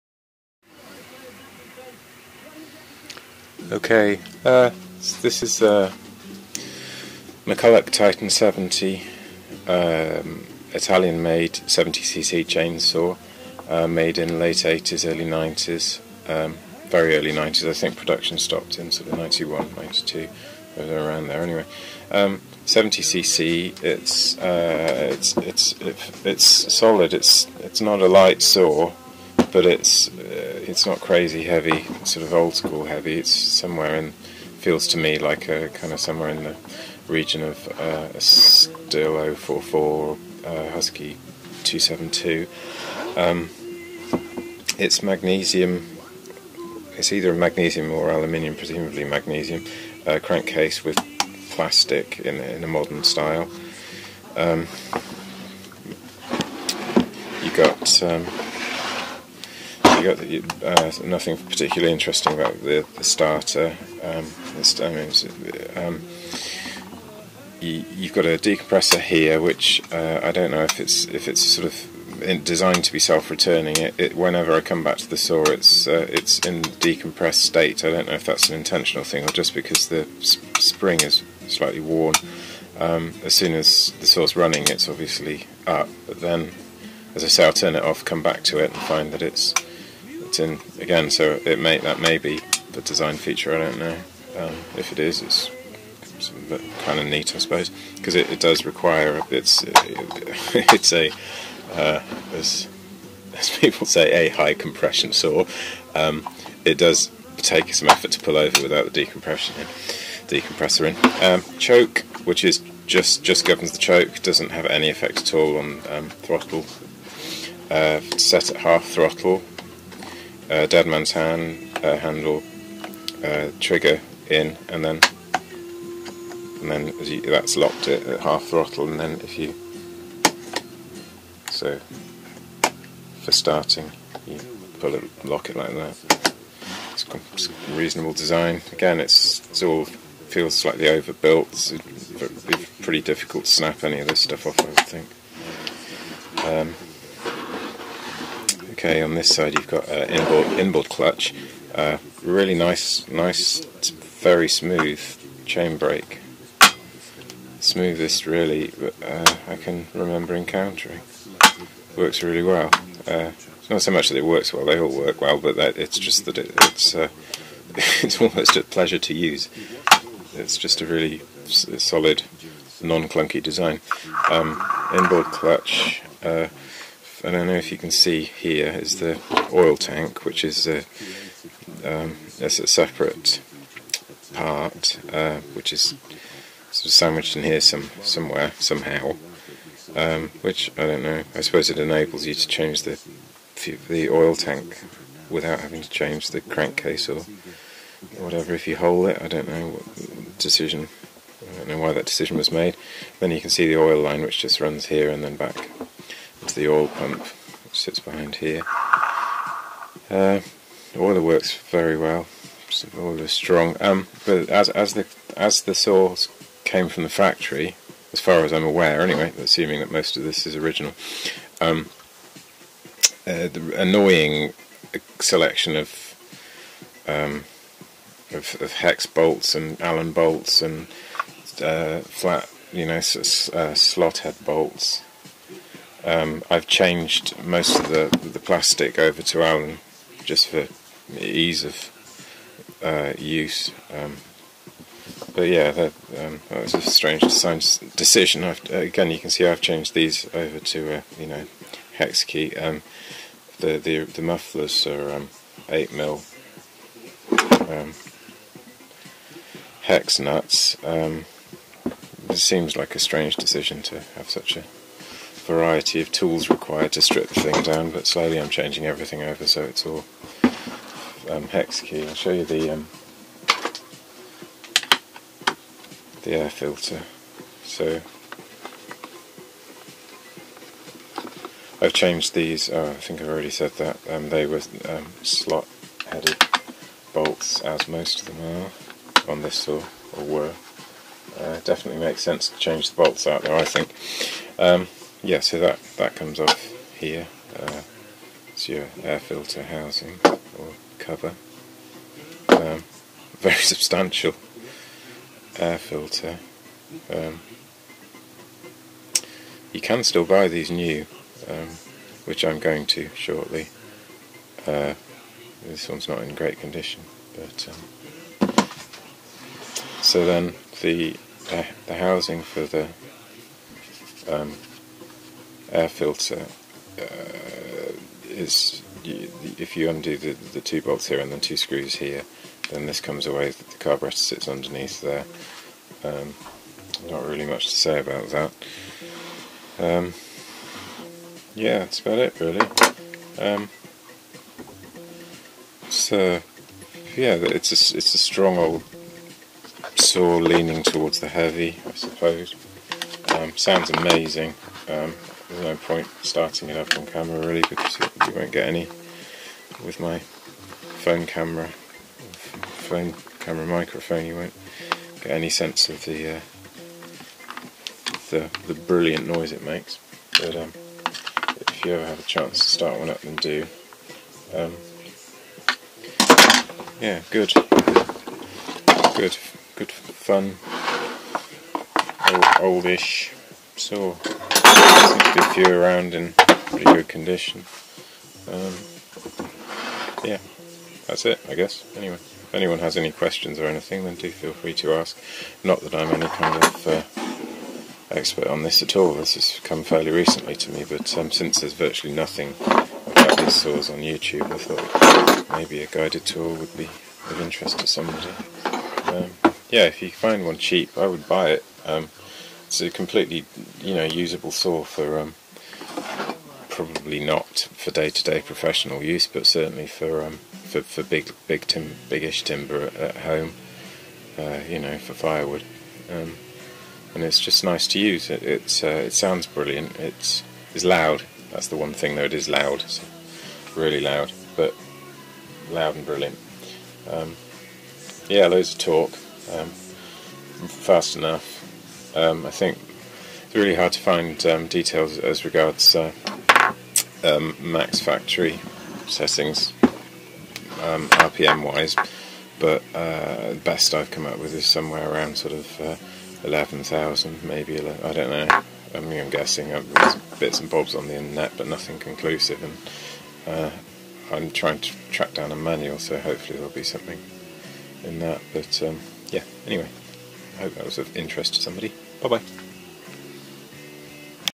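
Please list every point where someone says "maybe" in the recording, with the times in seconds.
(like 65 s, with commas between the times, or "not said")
405 s, 457 s.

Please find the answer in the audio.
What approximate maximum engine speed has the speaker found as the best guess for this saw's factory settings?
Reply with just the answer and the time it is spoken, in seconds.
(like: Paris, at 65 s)
11,000 RPM, at 456 s.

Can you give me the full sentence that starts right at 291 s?
Uh, definitely makes sense to change the bolts out there, I think.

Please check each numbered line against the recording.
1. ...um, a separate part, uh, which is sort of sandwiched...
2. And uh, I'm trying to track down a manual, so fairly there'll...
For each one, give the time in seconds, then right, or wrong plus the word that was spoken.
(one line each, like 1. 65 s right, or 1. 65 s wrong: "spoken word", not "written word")
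1. 181 s right
2. 462 s wrong: "hopefully", not "fairly".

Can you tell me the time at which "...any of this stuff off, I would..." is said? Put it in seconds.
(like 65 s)
143 s.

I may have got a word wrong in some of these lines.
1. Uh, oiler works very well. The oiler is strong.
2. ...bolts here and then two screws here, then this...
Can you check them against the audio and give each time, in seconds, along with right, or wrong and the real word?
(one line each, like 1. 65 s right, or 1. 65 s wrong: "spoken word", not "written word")
1. 210 s right
2. 330 s right.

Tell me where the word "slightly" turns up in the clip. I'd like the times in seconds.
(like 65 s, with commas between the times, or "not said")
81 s, 140 s.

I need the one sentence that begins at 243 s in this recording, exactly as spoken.
Um, but yeah, that, um, that, was a strange design decision.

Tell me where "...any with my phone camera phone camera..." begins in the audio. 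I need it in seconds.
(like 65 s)
358 s.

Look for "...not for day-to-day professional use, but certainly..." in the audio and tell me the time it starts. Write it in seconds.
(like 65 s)
417 s.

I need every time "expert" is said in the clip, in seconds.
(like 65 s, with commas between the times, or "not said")
398 s.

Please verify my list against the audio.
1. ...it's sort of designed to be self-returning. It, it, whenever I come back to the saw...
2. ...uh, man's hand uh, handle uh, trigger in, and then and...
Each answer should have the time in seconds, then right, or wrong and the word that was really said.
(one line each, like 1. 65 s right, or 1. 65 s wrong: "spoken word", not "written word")
1. 71 s right
2. 120 s right.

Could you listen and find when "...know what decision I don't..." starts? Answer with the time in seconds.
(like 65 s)
199 s.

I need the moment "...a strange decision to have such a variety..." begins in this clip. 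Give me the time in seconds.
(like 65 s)
262 s.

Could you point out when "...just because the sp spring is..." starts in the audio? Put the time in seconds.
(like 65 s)
79 s.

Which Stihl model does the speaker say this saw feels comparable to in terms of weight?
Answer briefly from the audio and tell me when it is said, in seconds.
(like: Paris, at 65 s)
Stihl 044, at 38 s.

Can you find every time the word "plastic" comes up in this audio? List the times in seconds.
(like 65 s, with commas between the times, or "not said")
51 s, 238 s.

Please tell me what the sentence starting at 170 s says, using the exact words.
It's just a really solid, non-clunky design.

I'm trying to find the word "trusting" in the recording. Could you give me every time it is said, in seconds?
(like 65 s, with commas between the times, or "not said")
not said.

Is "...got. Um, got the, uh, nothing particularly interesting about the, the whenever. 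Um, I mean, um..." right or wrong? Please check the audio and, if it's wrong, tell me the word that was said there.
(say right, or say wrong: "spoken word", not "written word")
wrong: "starter", not "whenever".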